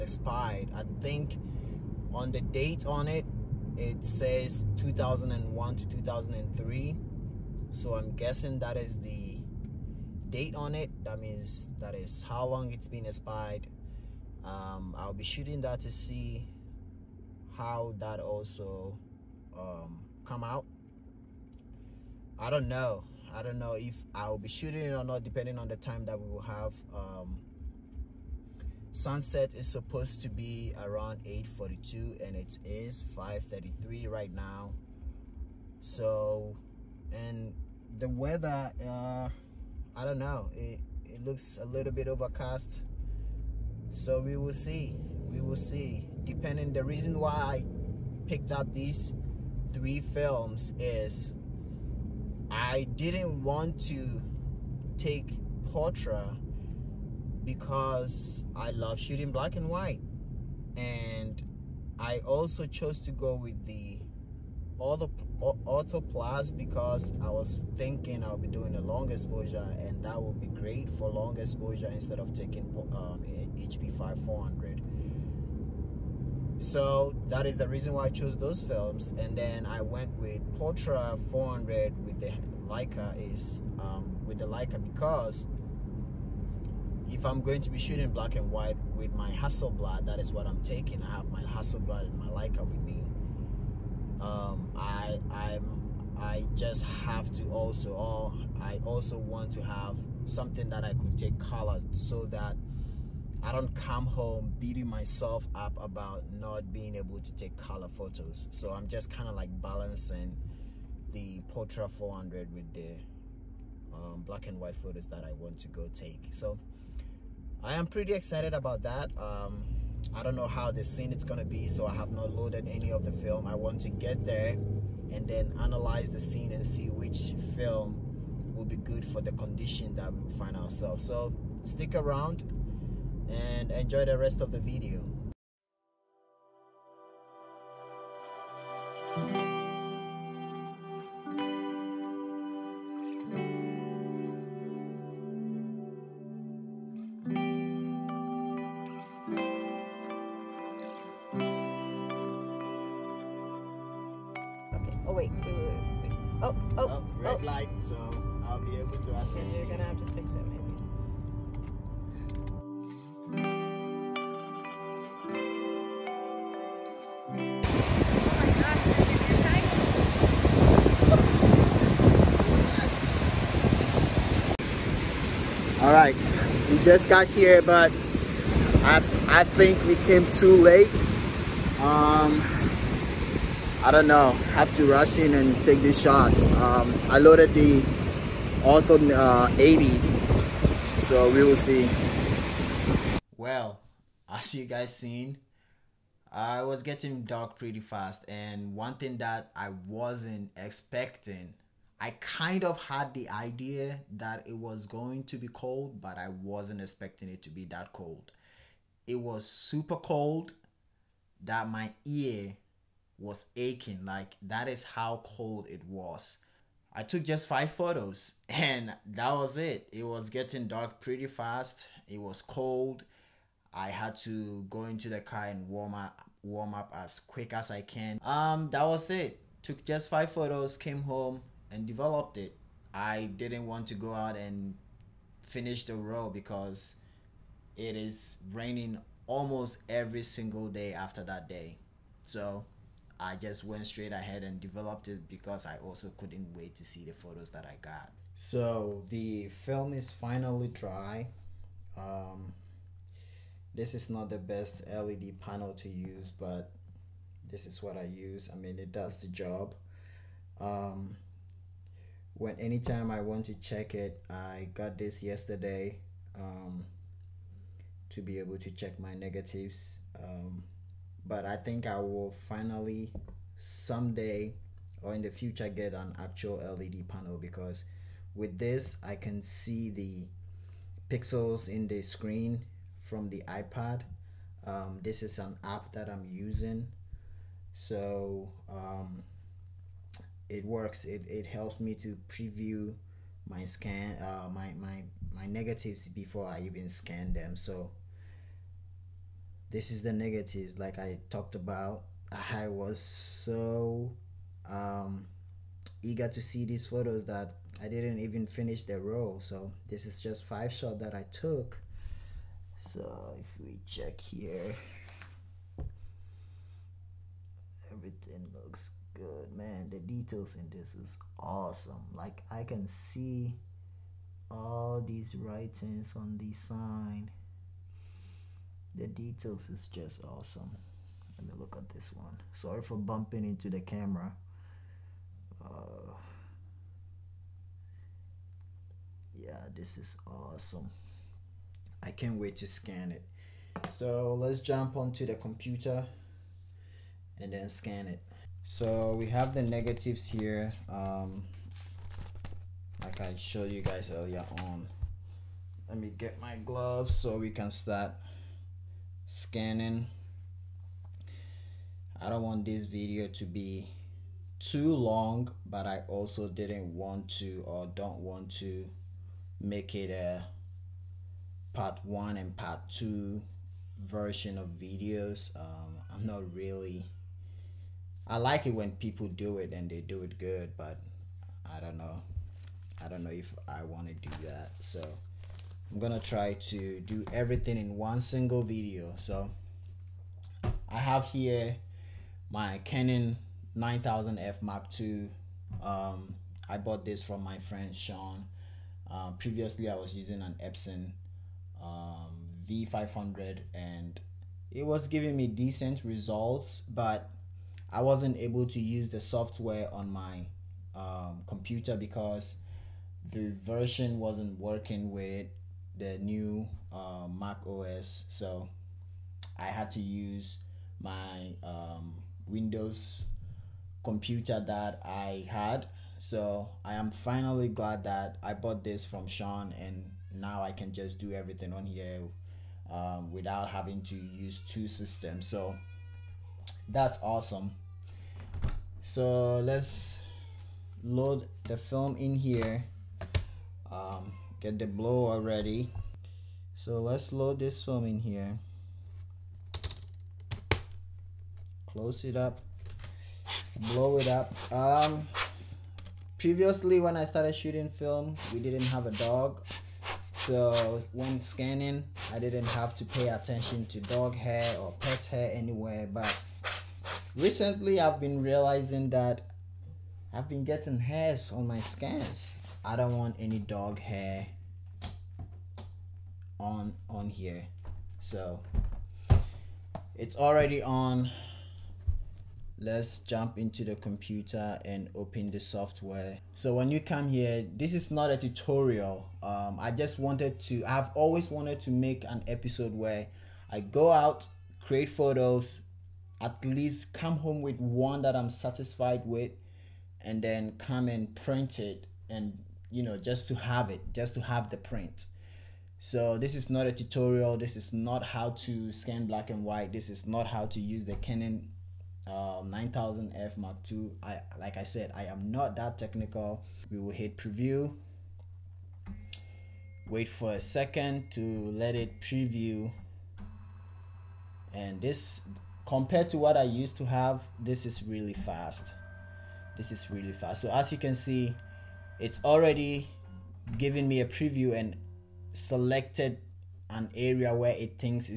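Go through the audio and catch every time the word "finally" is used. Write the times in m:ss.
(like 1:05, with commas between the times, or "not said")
4:10, 4:32, 7:07.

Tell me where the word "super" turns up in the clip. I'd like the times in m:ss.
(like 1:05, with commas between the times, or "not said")
3:29.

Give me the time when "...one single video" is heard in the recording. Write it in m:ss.
6:27.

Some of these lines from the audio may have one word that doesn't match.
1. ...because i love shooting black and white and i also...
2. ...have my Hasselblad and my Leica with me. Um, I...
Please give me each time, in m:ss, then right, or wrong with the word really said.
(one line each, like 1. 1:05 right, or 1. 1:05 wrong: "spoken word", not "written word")
1. 0:57 right
2. 1:31 right.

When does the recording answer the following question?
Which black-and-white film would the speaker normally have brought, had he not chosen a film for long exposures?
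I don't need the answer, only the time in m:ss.
1:13.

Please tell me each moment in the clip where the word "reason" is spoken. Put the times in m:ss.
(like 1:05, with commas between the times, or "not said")
0:46, 1:17.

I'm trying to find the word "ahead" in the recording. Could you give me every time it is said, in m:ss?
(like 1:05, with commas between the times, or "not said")
4:04.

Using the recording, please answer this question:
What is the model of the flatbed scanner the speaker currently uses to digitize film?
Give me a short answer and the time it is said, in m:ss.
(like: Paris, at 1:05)
Canon 9000F Mark II, at 6:32.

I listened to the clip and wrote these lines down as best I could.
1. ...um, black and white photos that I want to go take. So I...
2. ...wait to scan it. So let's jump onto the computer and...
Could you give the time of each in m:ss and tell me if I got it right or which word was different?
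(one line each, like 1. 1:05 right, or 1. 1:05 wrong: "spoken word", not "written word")
1. 1:53 right
2. 5:42 right.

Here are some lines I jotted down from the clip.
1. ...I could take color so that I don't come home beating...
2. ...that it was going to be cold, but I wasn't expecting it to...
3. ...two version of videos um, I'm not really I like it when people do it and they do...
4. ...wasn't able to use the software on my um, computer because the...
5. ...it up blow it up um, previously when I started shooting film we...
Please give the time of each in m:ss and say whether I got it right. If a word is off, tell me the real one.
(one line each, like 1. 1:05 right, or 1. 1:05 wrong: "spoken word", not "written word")
1. 1:40 right
2. 3:24 right
3. 6:12 right
4. 6:48 right
5. 7:32 right.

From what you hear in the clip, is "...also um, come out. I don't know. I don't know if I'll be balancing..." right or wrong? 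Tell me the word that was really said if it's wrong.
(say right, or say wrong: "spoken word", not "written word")
wrong: "shooting", not "balancing".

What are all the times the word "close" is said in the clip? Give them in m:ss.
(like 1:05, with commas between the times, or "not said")
7:31.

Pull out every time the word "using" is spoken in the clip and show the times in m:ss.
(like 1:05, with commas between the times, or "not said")
4:46, 6:40.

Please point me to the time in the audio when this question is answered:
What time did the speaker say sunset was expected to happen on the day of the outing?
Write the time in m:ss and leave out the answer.
0:31.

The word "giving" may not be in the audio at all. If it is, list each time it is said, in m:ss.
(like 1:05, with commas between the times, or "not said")
6:45, 8:53.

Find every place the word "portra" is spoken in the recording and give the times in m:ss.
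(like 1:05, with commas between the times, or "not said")
0:55, 1:20, 1:51.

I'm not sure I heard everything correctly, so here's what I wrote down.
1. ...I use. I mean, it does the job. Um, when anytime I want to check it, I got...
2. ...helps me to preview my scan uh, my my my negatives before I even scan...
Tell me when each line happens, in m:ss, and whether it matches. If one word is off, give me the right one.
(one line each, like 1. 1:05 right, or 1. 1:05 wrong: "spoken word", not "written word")
1. 4:17 right
2. 4:51 right.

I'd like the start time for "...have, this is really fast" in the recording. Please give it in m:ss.
8:47.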